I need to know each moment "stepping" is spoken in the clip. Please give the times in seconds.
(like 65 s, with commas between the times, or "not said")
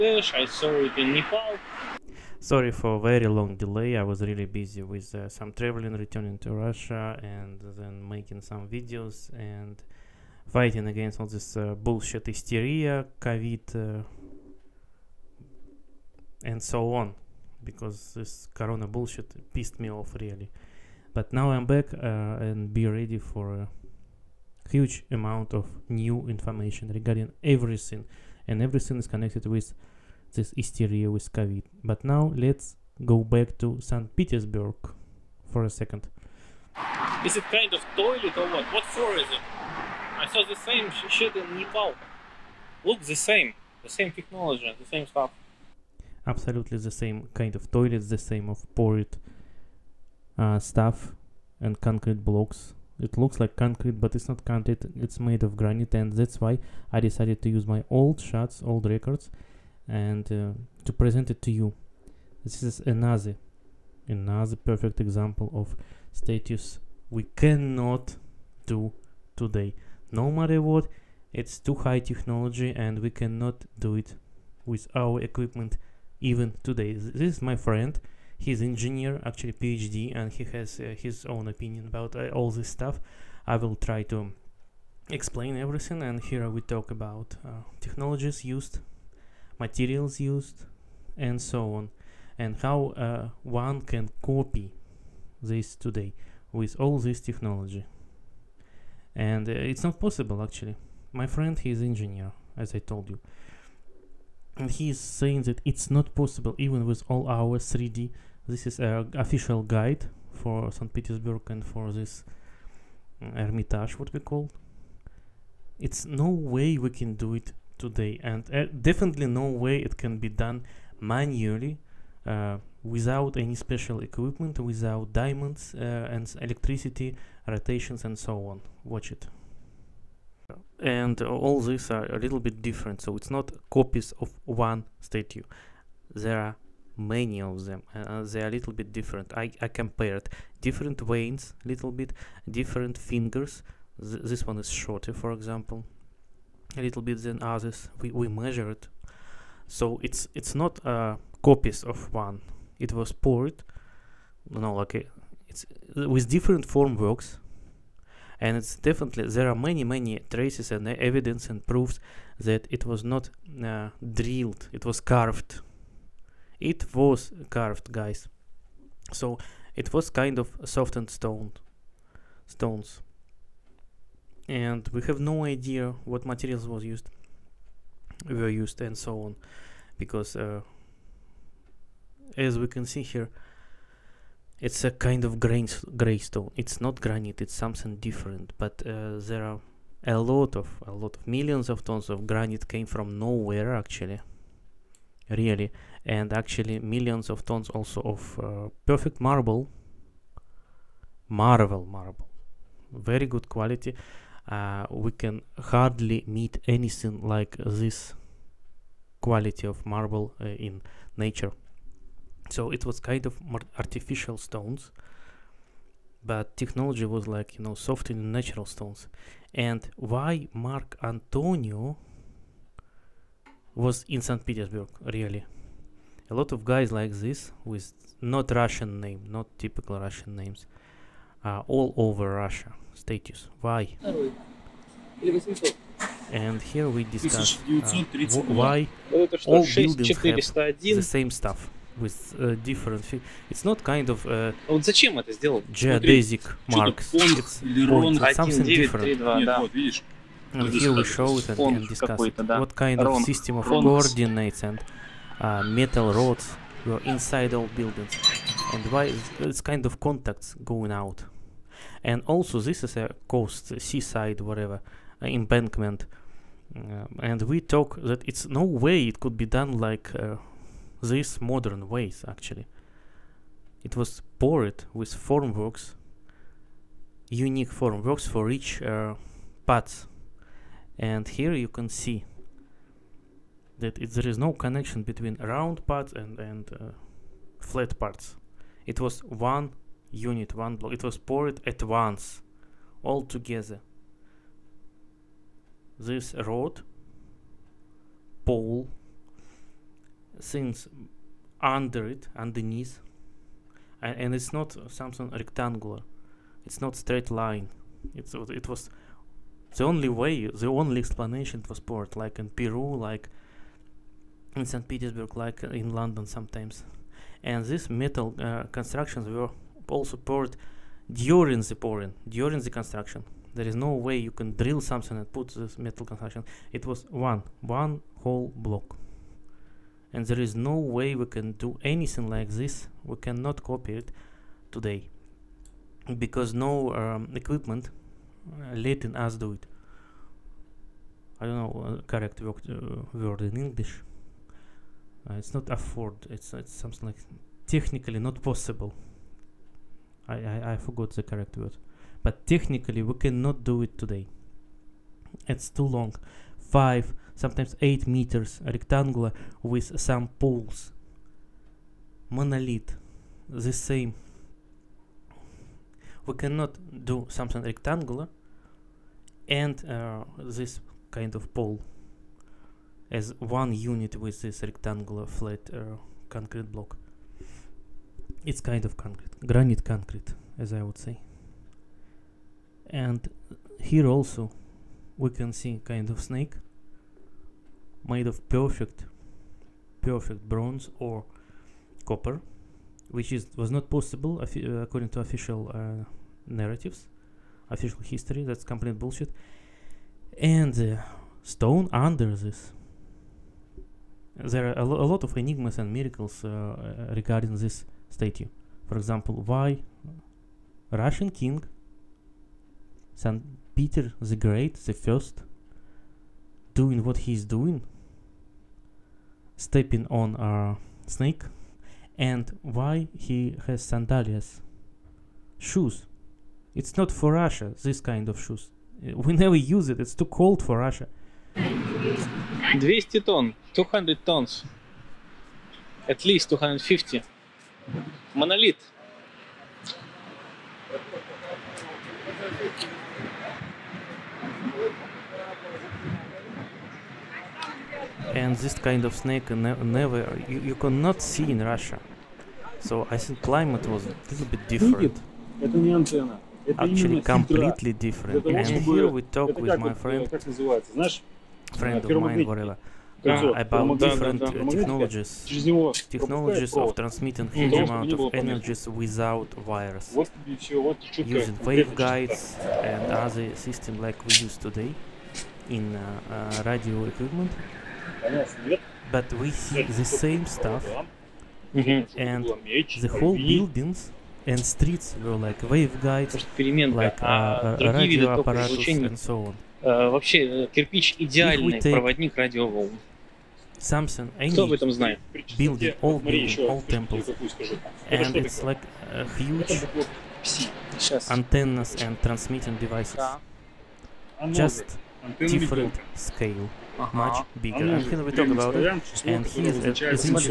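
419 s.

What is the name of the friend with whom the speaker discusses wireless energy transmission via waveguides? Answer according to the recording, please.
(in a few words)
Gorilla.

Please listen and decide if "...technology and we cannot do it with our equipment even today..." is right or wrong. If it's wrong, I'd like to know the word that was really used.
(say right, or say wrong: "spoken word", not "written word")
right.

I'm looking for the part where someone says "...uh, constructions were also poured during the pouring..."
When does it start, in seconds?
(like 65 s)
318 s.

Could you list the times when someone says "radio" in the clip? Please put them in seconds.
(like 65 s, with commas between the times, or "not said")
476 s, 487 s.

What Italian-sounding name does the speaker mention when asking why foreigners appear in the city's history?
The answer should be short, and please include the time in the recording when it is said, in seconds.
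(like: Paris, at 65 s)
Mark Antonio, at 220 s.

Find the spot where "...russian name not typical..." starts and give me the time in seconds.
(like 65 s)
228 s.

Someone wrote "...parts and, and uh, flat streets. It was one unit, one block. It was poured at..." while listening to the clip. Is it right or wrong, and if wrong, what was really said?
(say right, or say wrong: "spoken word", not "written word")
wrong: "parts", not "streets".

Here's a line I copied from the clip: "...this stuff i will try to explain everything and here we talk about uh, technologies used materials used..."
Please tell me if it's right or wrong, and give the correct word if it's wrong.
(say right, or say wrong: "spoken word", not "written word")
right.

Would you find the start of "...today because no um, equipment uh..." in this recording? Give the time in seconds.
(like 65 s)
334 s.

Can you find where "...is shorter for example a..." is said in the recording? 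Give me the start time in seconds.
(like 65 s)
144 s.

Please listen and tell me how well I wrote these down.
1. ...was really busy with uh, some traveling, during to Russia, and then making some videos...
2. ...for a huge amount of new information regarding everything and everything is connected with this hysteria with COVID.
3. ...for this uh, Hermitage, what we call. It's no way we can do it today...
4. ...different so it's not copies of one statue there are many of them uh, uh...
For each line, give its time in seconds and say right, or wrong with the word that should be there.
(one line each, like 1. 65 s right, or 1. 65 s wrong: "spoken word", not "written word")
1. 4 s wrong: "returning", not "during"
2. 23 s right
3. 111 s right
4. 132 s right.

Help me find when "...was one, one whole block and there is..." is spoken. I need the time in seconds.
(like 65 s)
326 s.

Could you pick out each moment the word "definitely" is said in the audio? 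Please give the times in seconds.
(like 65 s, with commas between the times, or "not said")
118 s, 158 s.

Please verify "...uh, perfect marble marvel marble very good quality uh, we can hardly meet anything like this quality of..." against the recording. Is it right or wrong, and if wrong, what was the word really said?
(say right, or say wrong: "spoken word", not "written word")
right.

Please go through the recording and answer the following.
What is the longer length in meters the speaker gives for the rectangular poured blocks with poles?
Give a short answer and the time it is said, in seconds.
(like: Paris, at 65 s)
8 meters, at 357 s.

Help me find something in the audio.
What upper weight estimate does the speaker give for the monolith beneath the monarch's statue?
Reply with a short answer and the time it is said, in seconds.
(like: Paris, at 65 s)
250 tons, at 436 s.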